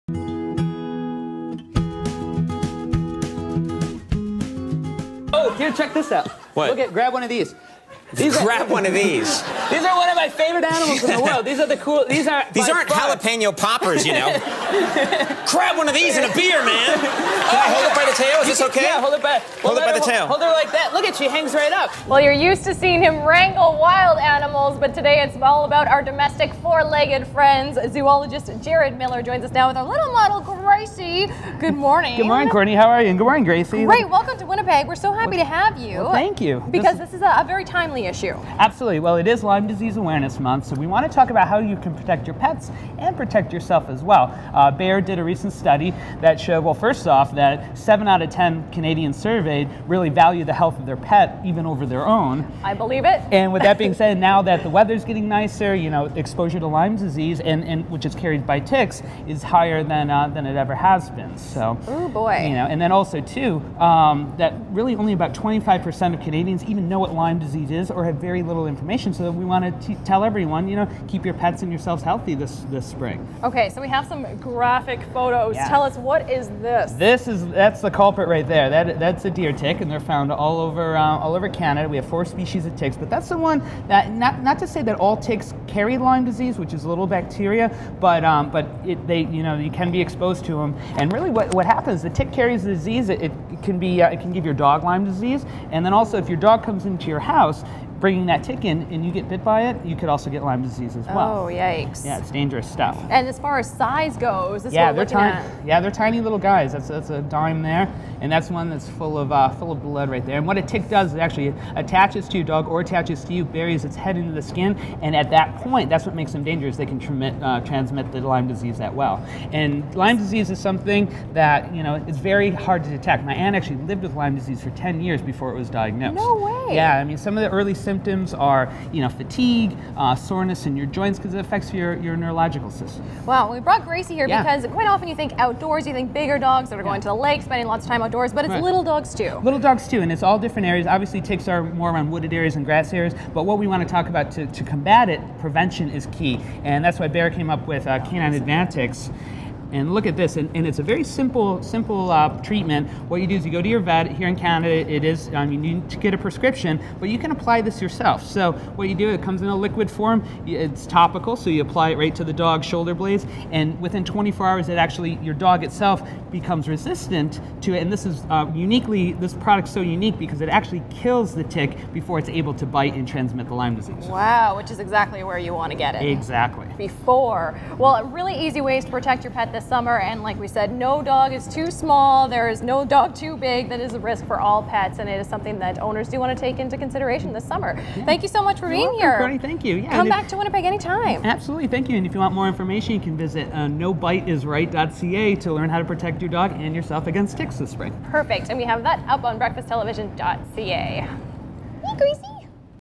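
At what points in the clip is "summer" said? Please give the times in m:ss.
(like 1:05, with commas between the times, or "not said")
2:59, 3:07.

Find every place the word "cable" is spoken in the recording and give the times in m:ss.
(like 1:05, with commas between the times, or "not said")
not said.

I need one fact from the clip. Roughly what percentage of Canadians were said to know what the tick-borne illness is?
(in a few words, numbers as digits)
25%.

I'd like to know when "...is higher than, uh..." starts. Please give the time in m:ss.
0:59.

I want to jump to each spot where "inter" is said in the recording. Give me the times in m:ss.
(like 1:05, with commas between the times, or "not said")
not said.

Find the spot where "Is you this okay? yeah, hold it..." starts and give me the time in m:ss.
0:18.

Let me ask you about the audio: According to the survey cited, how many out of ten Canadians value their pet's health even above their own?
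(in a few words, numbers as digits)
7.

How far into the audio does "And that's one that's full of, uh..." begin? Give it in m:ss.
1:48.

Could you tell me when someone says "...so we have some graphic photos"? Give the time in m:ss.
1:13.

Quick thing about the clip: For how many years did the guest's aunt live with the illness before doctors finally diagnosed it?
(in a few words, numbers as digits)
10.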